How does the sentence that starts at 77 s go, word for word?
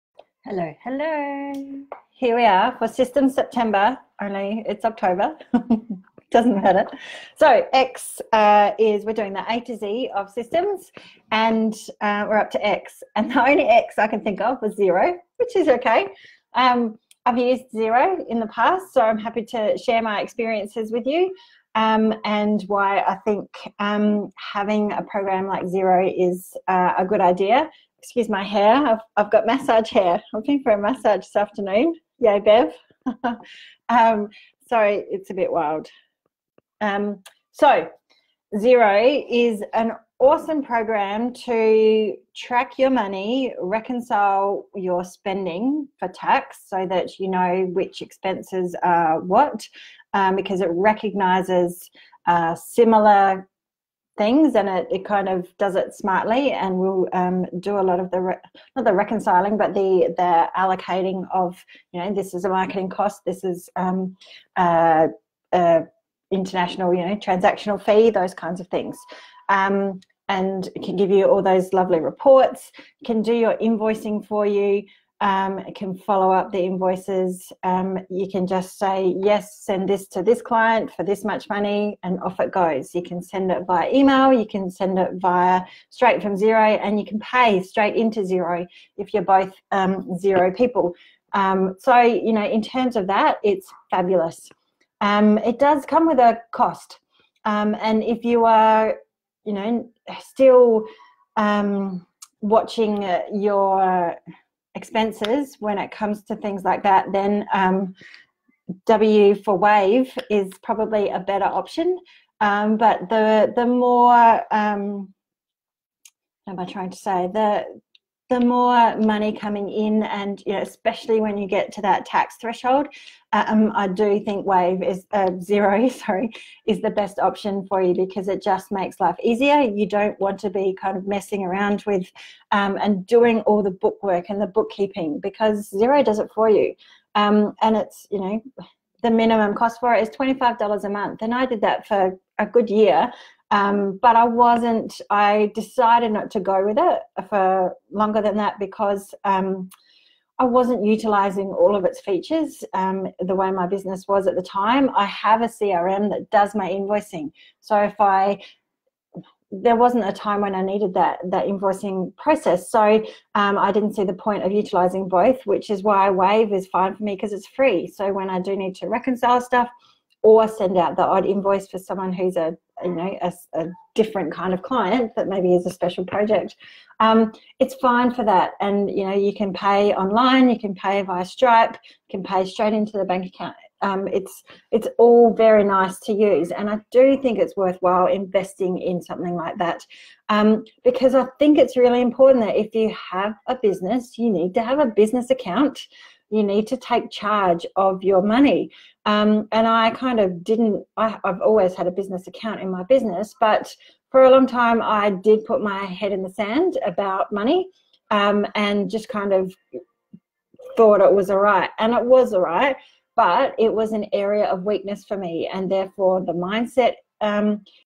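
Um, you can just say, yes, send this to this client for this much money, and off it goes.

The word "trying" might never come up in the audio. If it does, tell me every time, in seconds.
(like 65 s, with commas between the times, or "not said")
116 s.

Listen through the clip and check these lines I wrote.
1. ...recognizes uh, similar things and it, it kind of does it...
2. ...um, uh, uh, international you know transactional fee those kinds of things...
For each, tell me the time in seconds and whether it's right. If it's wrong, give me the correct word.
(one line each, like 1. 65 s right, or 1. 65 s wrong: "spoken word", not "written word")
1. 50 s right
2. 63 s right.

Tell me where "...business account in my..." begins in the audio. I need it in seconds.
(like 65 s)
201 s.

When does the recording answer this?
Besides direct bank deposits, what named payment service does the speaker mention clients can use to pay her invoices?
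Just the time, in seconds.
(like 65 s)
181 s.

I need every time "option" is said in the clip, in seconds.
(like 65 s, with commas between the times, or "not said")
111 s, 127 s.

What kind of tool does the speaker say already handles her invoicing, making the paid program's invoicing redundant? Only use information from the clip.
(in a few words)
CRM.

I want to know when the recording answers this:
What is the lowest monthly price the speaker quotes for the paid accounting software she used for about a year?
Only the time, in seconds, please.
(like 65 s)
140 s.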